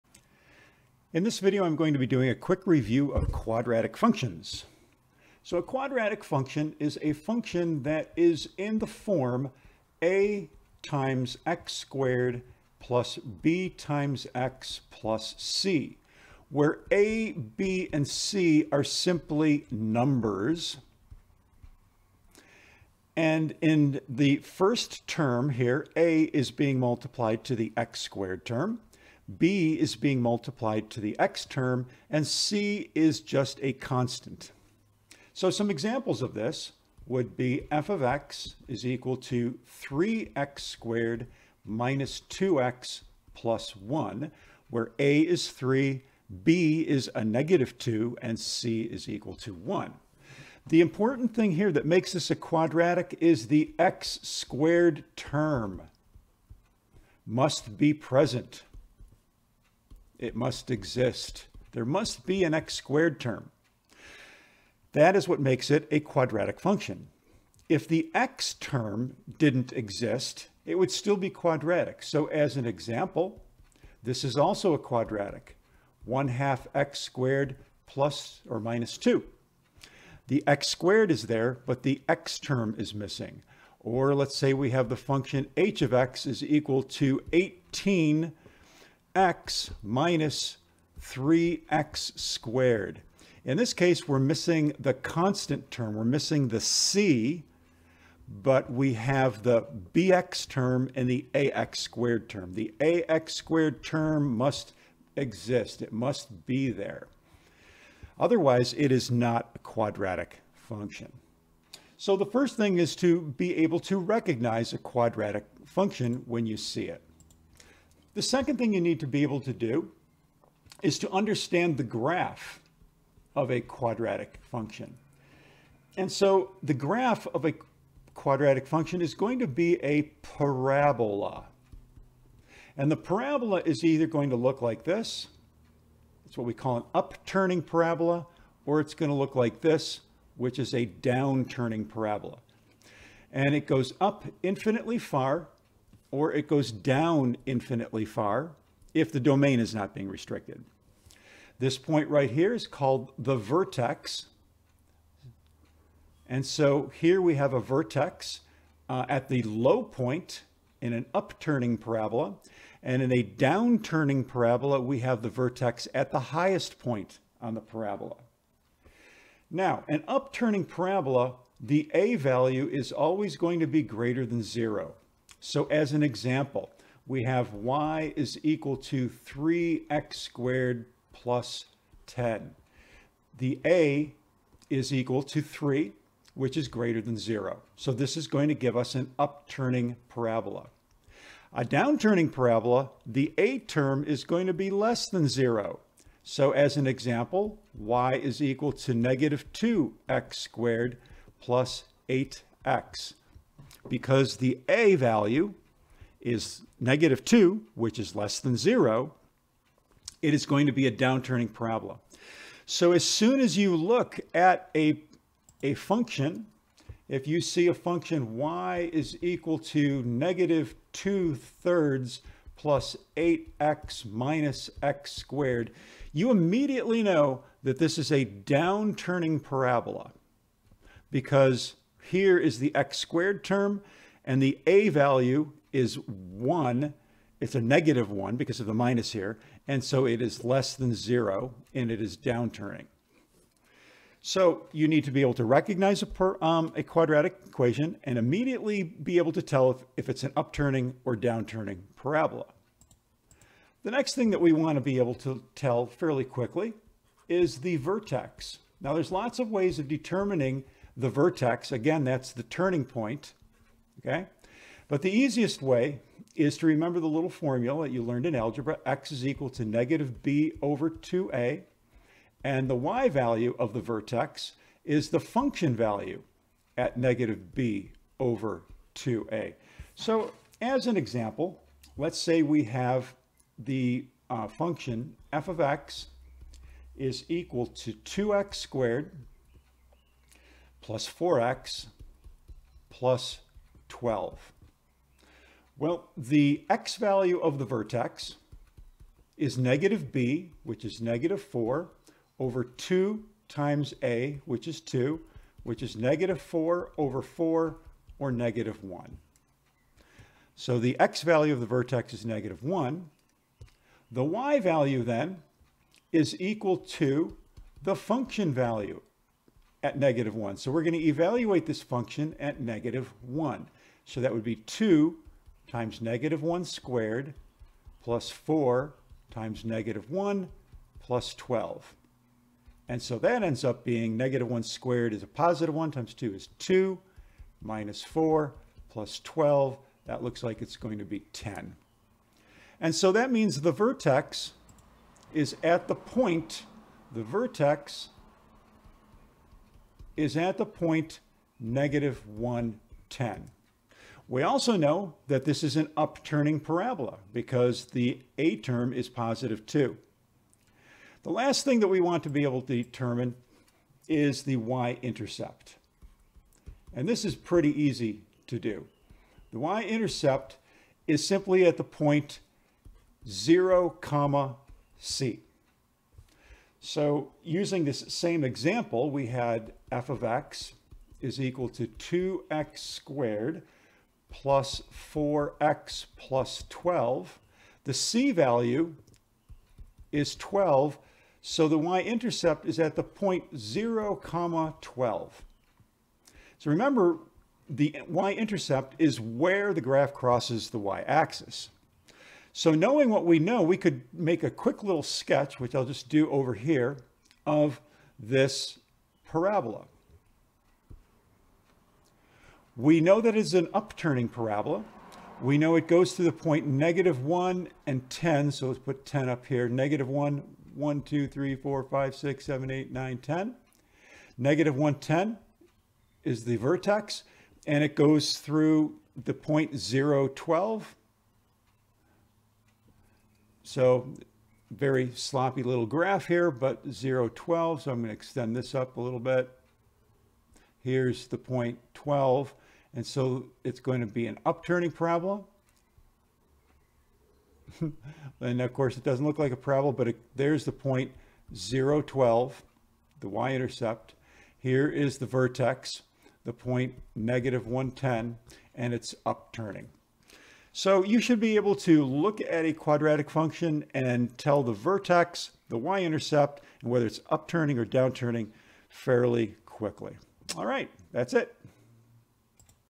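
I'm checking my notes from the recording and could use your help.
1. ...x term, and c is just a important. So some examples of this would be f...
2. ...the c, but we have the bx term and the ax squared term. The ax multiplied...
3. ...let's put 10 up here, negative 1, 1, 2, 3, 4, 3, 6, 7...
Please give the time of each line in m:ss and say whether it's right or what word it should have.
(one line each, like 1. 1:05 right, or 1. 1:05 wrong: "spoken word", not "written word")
1. 0:31 wrong: "constant", not "important"
2. 1:36 wrong: "squared", not "multiplied"
3. 6:58 wrong: "5", not "3".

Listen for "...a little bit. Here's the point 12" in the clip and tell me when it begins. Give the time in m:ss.
7:18.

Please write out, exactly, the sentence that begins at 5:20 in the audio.
So we're going to evaluate this function at negative 1.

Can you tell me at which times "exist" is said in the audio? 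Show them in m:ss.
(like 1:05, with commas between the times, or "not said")
1:00, 1:09, 1:45.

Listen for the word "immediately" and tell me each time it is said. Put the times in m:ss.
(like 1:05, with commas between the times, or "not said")
3:46, 4:08.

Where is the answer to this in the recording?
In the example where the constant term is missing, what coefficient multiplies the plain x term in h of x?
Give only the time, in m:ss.
1:27.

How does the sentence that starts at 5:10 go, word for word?
So the x value of the vertex is negative 1.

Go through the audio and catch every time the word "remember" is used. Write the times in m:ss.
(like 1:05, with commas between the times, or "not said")
4:26, 6:36.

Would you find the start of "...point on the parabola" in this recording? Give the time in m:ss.
2:46.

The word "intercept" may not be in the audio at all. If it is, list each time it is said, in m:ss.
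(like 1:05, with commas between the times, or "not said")
6:04, 6:09, 6:31, 6:38, 7:33, 7:45.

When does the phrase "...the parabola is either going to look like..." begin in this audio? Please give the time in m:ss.
2:12.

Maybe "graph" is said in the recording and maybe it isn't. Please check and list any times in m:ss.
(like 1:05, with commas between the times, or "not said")
2:01, 2:06, 6:39, 7:15.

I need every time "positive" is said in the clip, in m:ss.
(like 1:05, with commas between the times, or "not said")
5:35, 5:59.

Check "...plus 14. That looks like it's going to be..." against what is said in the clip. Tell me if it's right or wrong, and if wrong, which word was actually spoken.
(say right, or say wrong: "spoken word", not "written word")
wrong: "12", not "14".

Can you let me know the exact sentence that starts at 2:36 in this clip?
And so here we have a vertex uh, at the low point in an upturning parabola.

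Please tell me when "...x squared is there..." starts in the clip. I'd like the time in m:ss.
1:20.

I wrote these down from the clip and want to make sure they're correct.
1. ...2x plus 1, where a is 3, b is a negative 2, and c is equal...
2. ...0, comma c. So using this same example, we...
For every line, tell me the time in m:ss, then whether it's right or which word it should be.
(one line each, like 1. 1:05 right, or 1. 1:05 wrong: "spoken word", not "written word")
1. 0:42 right
2. 6:13 right.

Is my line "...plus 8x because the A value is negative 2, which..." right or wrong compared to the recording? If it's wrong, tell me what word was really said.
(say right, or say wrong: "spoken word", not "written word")
right.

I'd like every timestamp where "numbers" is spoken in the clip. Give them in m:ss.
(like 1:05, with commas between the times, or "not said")
0:19.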